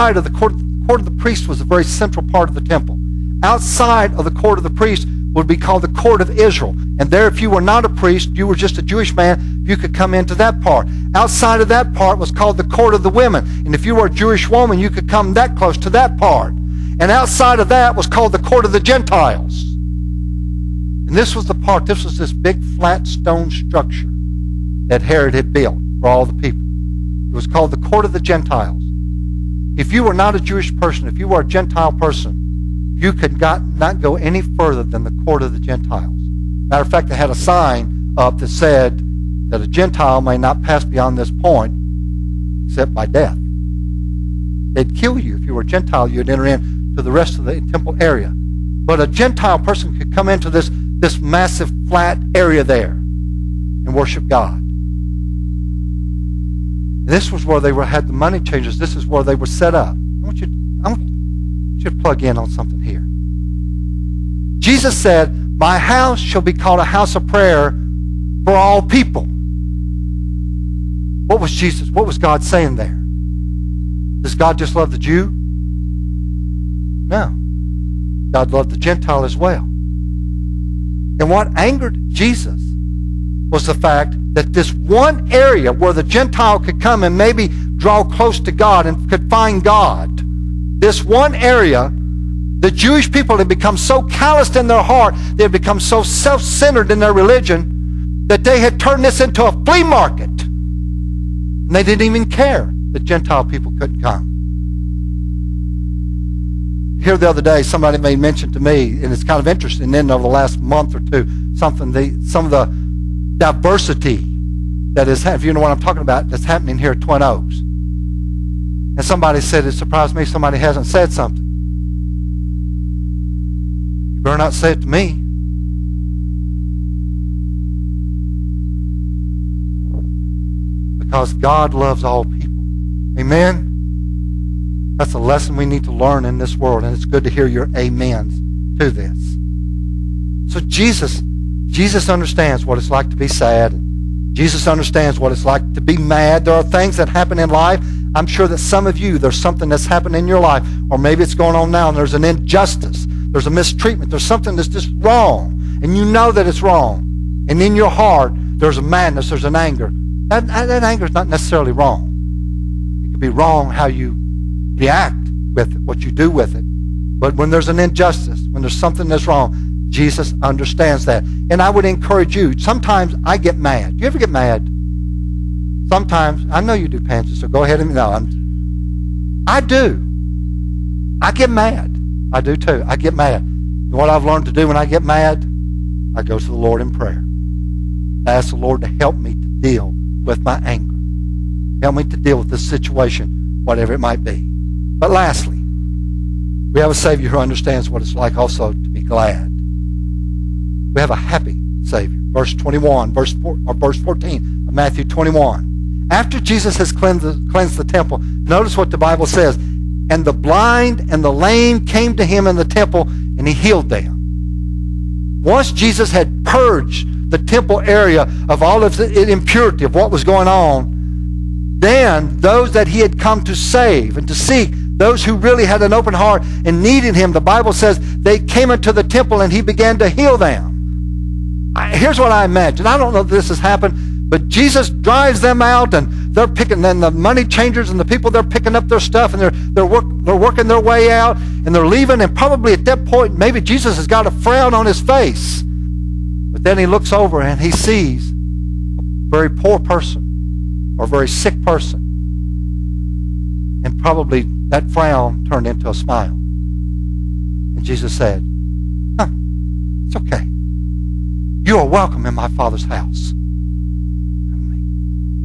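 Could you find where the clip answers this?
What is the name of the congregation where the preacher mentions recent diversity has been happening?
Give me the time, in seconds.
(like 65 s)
117 s.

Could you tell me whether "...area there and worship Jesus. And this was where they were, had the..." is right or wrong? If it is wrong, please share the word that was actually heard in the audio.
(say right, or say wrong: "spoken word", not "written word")
wrong: "God", not "Jesus".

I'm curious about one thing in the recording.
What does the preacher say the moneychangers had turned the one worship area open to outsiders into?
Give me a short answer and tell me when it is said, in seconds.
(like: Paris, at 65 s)
A flea market, at 99 s.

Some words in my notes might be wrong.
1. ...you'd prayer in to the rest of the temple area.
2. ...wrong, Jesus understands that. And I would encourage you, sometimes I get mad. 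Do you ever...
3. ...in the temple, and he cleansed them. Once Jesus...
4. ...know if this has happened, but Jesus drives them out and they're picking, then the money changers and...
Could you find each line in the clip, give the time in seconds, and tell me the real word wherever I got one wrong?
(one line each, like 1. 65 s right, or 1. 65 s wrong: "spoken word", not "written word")
1. 46 s wrong: "enter", not "prayer"
2. 169 s right
3. 212 s wrong: "healed", not "cleansed"
4. 233 s right.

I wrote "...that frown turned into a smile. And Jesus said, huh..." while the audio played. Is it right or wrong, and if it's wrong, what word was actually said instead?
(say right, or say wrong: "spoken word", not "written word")
right.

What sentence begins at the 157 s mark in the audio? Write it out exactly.
And in your heart, there's a madness, there's an anger.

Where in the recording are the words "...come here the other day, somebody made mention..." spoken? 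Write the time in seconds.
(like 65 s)
104 s.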